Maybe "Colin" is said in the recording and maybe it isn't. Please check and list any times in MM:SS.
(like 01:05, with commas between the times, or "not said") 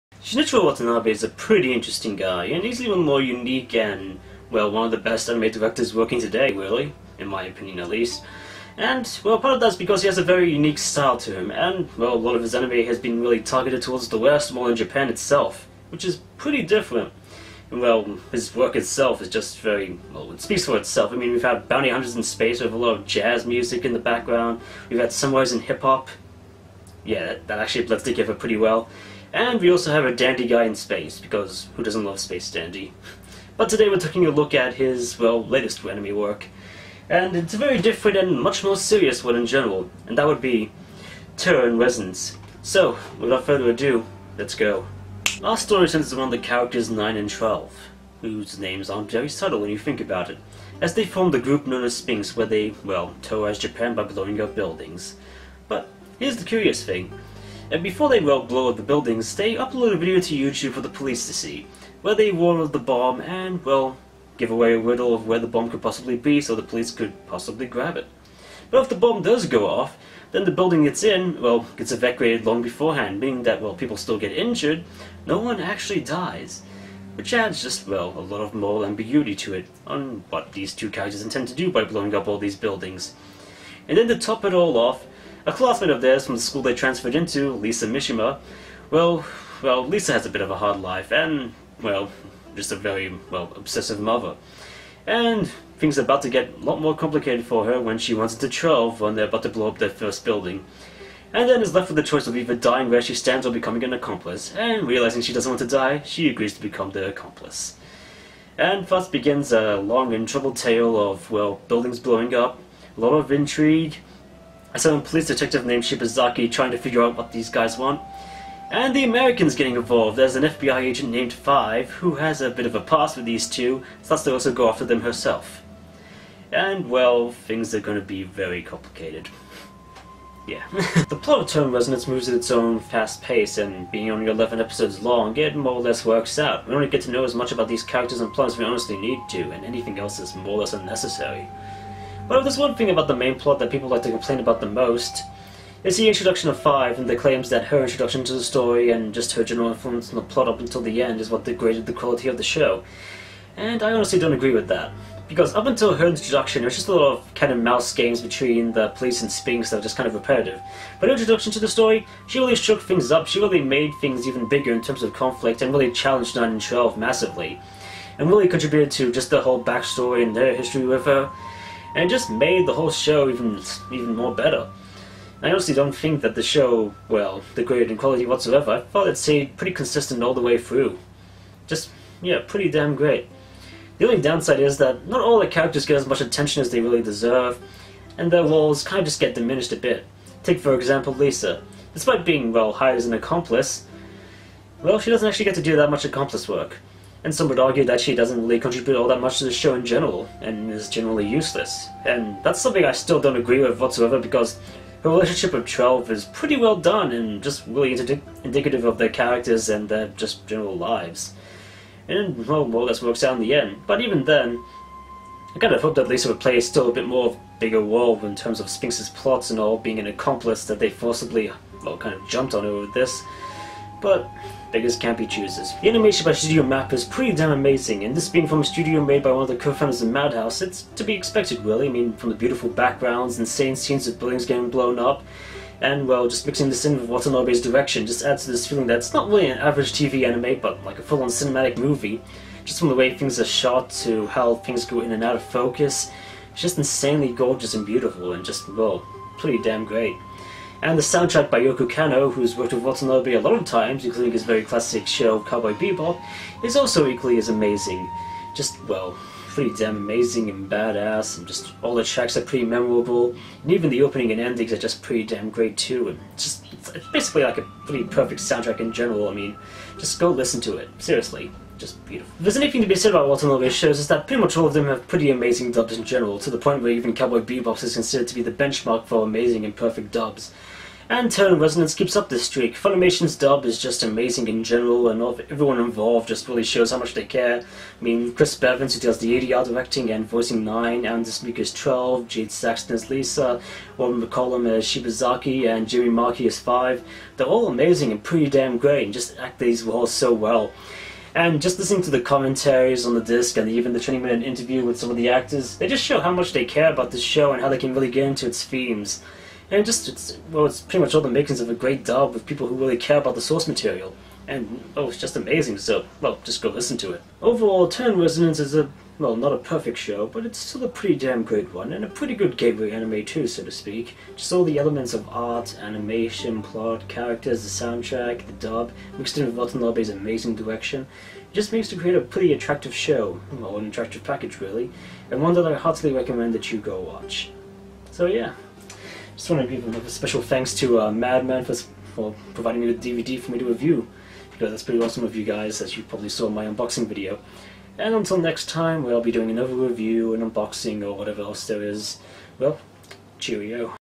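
not said.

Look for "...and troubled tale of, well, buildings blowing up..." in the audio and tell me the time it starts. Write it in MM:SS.
01:50.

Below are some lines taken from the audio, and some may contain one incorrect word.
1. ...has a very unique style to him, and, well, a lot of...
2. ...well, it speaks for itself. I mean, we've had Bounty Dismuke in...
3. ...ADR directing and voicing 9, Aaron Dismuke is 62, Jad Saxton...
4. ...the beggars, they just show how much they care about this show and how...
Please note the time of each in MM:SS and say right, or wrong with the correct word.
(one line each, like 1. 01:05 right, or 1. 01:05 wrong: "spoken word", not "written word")
1. 00:10 right
2. 00:20 wrong: "Hunters", not "Dismuke"
3. 04:49 wrong: "12", not "62"
4. 05:05 wrong: "actors", not "beggars".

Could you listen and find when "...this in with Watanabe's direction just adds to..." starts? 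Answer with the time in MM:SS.
03:56.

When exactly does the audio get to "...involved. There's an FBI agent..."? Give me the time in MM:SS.
01:59.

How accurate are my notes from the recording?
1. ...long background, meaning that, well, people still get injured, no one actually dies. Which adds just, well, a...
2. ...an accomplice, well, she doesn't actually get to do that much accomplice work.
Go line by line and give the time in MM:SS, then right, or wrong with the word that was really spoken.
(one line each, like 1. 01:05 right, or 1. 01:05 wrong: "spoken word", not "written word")
1. 01:12 wrong: "beforehand", not "background"
2. 03:13 right.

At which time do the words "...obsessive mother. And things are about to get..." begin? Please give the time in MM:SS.
01:33.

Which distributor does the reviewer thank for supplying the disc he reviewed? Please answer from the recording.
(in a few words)
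Madman.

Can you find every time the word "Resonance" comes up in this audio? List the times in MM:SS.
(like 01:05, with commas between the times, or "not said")
00:41, 02:11, 04:41, 05:18.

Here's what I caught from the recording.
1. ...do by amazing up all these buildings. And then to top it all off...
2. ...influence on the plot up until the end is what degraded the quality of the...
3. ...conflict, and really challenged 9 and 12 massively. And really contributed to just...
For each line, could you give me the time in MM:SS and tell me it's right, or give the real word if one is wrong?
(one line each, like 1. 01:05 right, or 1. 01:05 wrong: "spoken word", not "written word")
1. 01:21 wrong: "blowing", not "amazing"
2. 02:29 right
3. 02:45 right.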